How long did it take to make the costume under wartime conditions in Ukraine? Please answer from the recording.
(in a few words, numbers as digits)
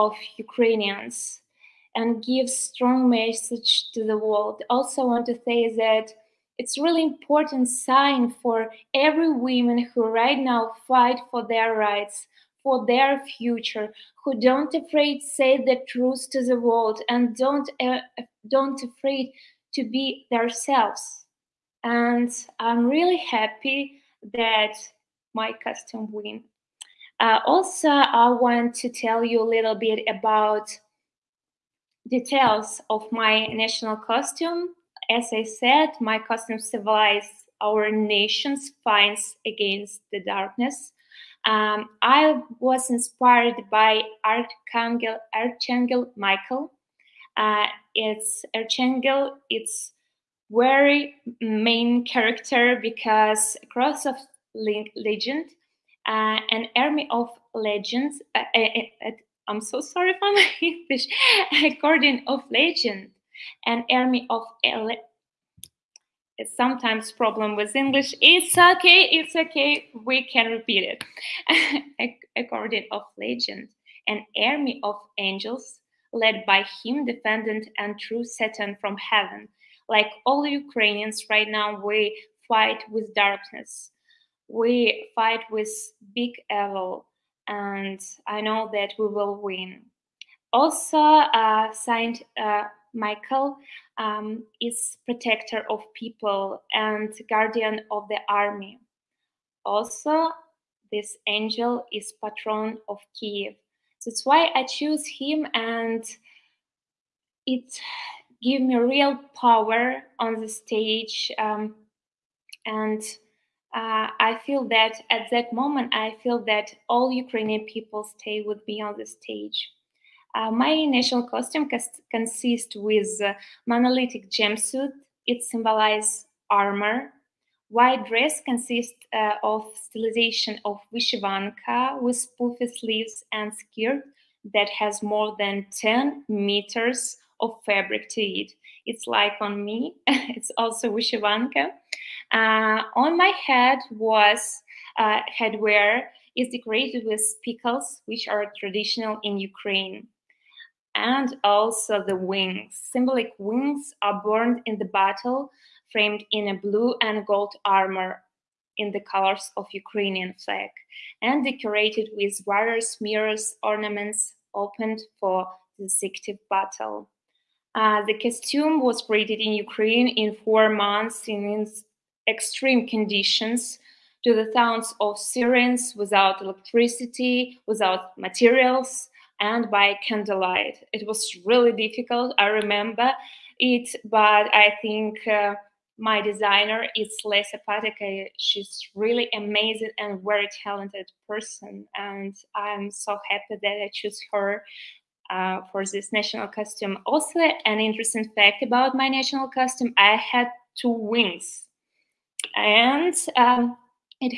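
4 months.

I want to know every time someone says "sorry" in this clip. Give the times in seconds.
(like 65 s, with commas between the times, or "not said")
59 s.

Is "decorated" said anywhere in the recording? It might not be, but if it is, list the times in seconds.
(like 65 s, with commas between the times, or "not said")
146 s, 161 s.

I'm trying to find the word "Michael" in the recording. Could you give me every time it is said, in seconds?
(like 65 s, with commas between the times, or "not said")
46 s, 92 s.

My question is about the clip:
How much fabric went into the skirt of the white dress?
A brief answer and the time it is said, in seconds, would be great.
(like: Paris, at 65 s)
more than 10 meters, at 135 s.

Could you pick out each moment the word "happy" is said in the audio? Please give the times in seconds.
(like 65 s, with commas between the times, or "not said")
23 s, 193 s.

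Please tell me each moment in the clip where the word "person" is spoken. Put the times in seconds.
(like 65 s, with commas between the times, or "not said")
191 s.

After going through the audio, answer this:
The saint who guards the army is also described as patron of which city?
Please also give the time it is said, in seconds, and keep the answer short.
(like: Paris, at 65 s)
Kiev, at 103 s.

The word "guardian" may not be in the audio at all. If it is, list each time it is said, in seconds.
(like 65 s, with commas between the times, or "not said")
61 s, 97 s.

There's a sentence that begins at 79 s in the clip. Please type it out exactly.
Like all Ukrainians right now, we fight with darkness.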